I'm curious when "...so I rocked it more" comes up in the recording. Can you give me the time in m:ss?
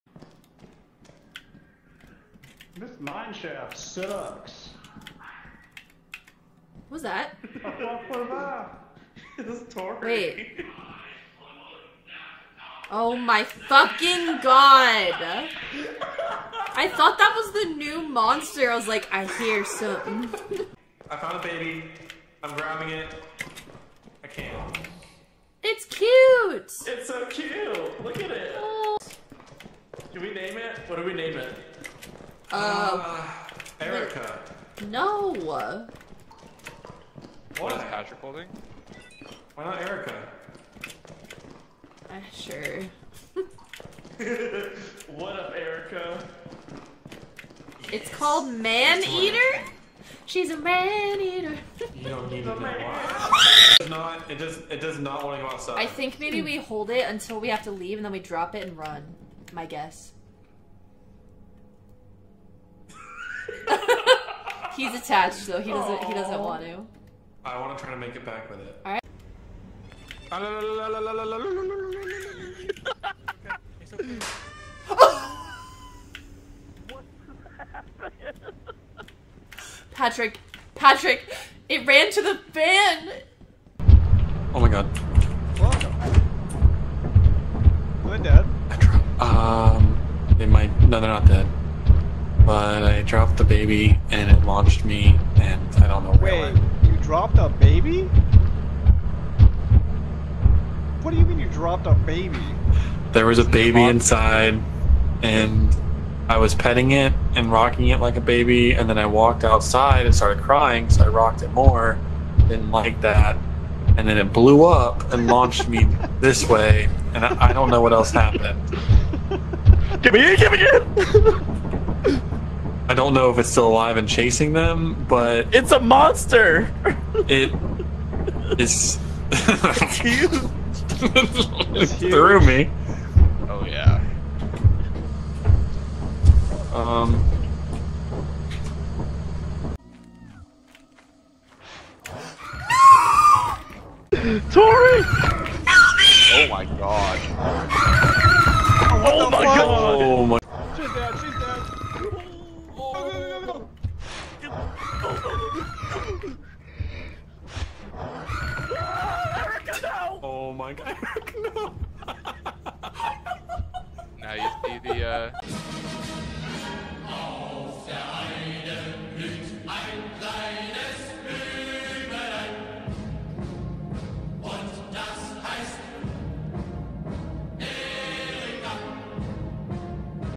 1:50.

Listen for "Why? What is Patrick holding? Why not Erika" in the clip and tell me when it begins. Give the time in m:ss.
0:35.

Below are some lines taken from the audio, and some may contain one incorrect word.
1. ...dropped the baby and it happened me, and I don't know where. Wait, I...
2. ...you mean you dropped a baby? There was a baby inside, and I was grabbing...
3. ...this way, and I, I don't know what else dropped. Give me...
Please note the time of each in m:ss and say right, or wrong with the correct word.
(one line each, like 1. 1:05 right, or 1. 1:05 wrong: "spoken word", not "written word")
1. 1:33 wrong: "launched", not "happened"
2. 1:41 wrong: "petting", not "grabbing"
3. 1:56 wrong: "happened", not "dropped".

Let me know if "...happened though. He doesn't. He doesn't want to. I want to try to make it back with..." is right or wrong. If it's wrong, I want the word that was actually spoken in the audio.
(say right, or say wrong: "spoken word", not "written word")
wrong: "attached", not "happened".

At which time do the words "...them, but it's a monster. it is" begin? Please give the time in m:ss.
2:04.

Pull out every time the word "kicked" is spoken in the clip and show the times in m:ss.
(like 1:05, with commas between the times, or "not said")
not said.